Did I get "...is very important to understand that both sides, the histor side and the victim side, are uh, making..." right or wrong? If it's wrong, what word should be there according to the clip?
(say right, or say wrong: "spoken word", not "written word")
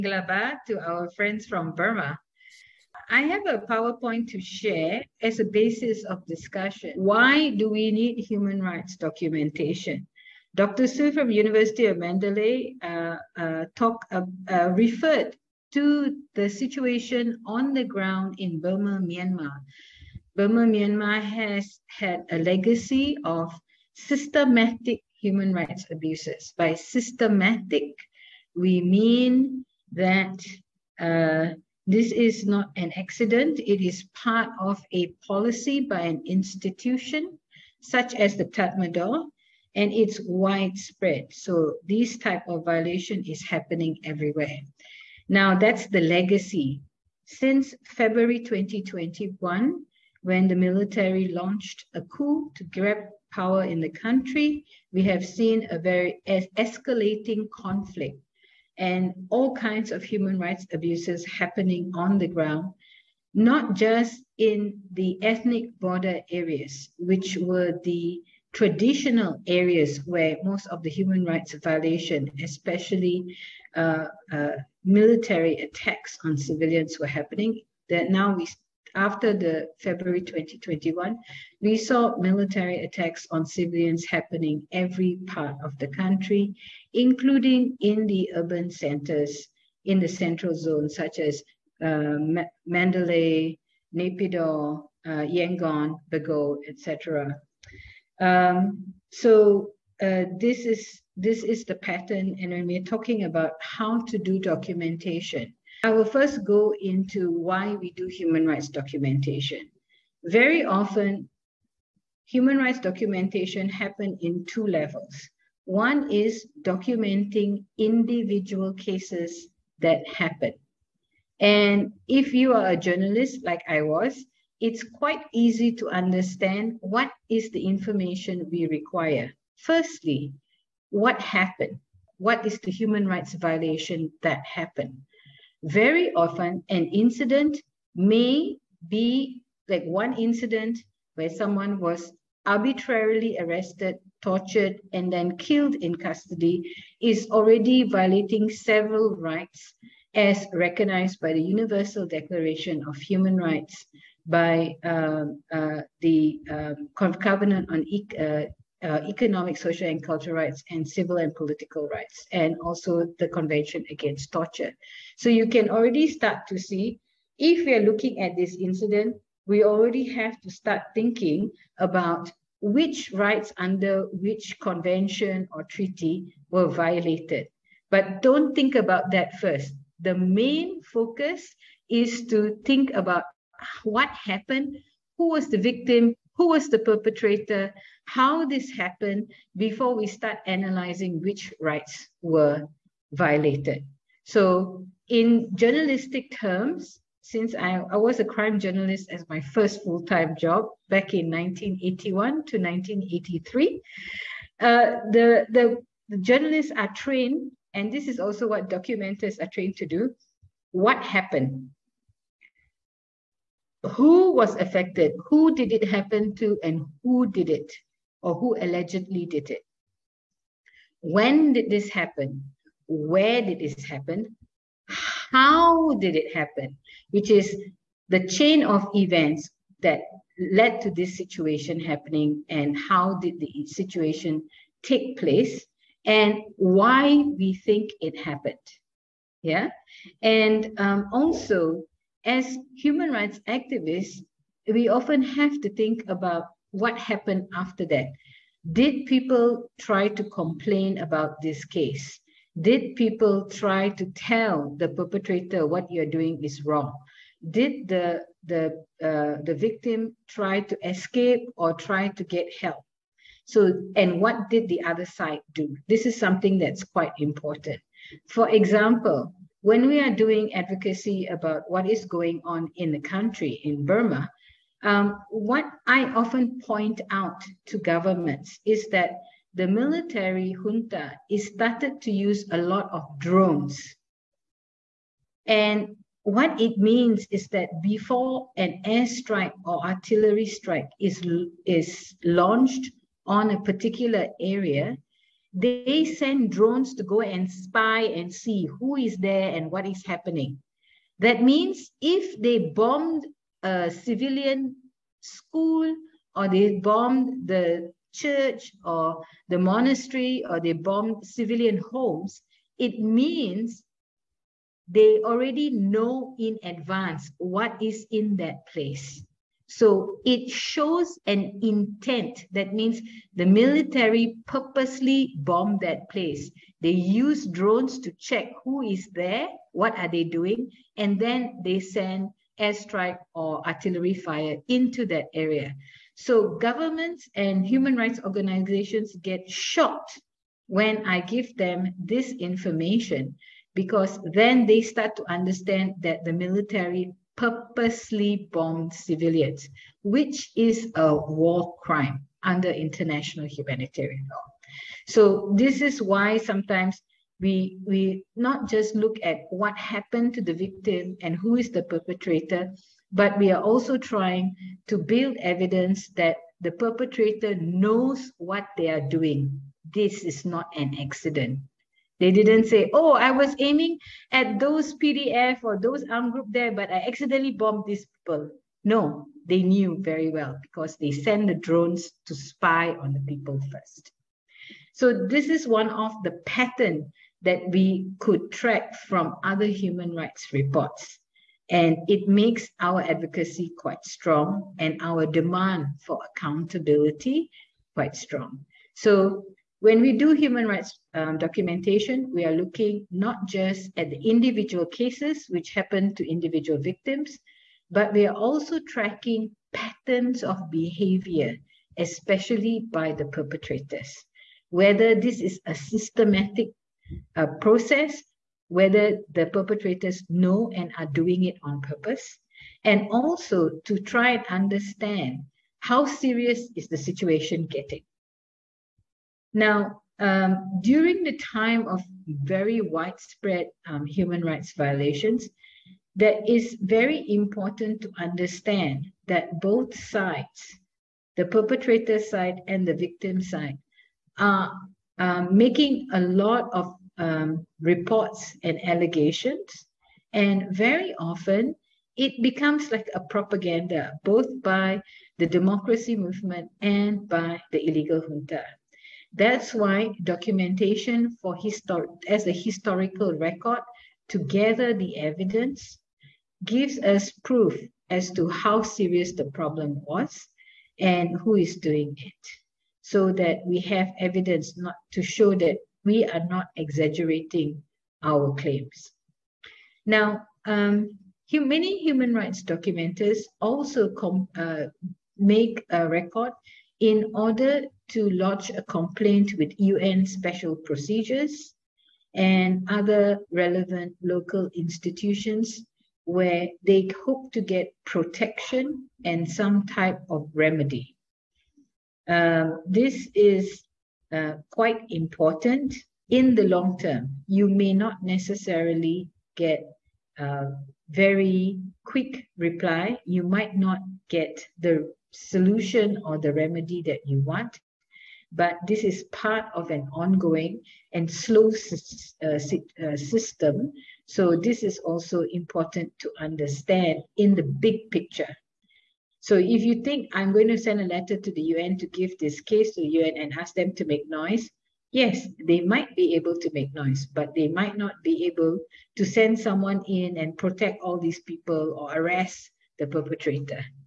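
wrong: "perpetrator", not "histor".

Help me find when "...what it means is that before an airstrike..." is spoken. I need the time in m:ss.
4:46.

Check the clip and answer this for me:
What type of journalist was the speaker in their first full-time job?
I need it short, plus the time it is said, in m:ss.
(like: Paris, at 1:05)
crime journalist, at 3:18.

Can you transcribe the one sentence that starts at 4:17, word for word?
Did the, the, uh, the victim try to escape or try to get help?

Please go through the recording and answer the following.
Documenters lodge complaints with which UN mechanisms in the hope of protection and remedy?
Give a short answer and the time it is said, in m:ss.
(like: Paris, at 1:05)
UN special procedures, at 8:09.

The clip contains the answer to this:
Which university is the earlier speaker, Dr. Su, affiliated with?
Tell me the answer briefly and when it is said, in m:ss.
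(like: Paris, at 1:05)
University of Mandalay, at 0:11.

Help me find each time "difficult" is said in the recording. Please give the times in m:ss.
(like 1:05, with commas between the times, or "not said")
not said.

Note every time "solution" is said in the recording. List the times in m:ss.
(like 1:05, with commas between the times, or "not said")
8:35.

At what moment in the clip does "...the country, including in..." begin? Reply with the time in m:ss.
1:25.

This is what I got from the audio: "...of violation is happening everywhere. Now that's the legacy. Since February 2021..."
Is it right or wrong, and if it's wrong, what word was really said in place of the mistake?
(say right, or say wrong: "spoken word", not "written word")
right.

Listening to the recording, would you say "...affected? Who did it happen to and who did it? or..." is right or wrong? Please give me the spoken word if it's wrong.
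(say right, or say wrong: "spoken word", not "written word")
right.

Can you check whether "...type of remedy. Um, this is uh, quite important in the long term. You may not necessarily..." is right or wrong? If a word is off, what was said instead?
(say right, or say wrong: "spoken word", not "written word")
right.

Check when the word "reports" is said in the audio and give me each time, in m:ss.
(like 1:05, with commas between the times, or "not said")
6:30, 7:27.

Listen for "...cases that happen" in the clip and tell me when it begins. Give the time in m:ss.
1:58.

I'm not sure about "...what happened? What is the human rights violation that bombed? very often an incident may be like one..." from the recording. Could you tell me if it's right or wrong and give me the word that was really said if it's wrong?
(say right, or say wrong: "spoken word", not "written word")
wrong: "happened", not "bombed".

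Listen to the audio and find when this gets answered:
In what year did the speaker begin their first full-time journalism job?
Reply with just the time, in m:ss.
3:21.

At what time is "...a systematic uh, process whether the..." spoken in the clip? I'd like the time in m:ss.
6:55.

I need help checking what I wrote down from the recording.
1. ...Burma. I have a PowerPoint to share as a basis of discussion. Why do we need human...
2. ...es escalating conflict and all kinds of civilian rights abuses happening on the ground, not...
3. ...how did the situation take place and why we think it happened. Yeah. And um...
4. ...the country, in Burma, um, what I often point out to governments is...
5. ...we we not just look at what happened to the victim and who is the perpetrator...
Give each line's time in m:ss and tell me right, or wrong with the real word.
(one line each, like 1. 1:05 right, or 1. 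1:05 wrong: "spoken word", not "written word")
1. 0:01 right
2. 0:56 wrong: "human", not "civilian"
3. 3:52 right
4. 4:32 right
5. 5:57 right.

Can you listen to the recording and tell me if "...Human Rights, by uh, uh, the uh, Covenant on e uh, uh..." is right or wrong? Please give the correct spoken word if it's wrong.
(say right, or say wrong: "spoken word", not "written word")
right.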